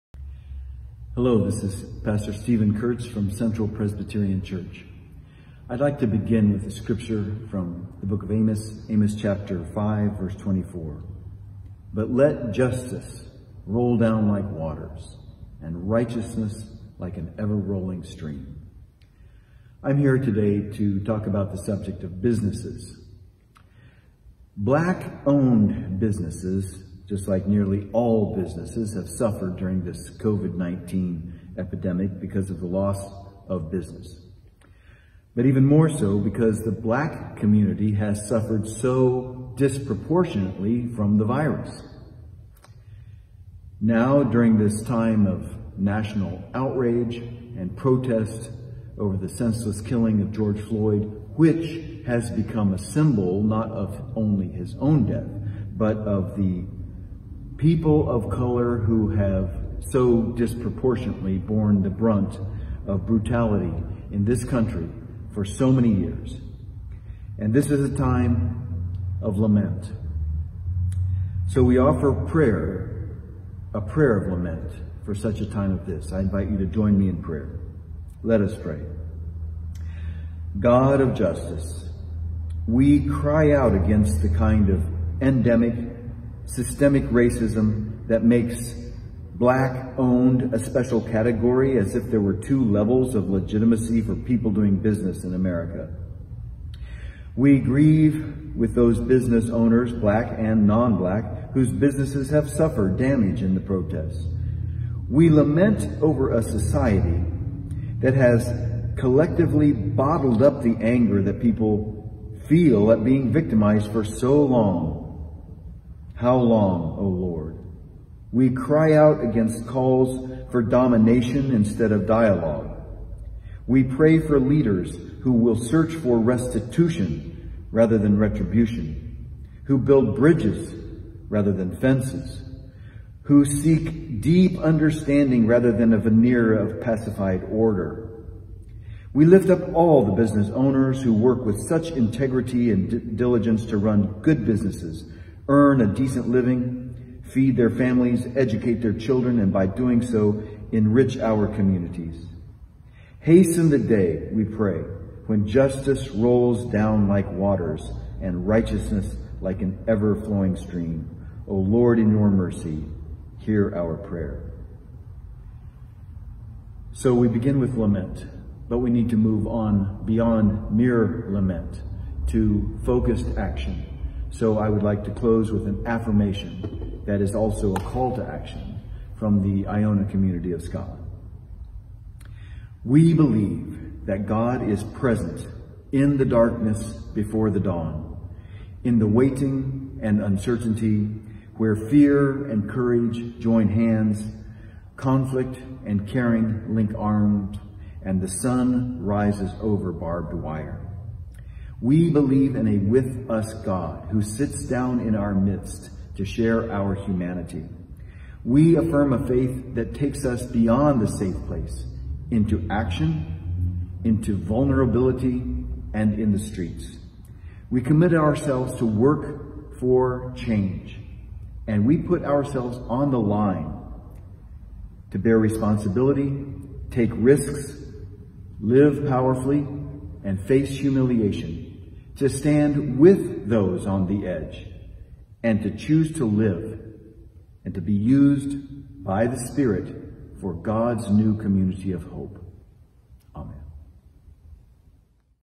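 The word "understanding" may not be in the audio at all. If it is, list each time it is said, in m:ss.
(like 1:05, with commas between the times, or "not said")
2:14.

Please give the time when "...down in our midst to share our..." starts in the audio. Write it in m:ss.
3:24.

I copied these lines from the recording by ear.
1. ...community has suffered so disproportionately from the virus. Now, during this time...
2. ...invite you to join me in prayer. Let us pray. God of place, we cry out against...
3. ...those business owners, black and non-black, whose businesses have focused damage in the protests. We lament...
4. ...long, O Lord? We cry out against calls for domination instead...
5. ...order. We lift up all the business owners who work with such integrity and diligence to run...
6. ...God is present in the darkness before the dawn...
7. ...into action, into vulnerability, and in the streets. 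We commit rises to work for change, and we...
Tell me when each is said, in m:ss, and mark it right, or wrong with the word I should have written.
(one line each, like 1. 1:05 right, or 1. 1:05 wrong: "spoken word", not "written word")
1. 0:37 right
2. 1:16 wrong: "justice", not "place"
3. 1:38 wrong: "suffered", not "focused"
4. 1:56 right
5. 2:17 right
6. 3:04 right
7. 3:32 wrong: "ourselves", not "rises".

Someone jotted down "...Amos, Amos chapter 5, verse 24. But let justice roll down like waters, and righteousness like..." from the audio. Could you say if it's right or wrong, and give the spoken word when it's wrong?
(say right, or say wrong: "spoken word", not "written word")
right.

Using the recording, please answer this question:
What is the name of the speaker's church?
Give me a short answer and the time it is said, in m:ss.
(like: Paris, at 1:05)
Central Presbyterian Church, at 0:03.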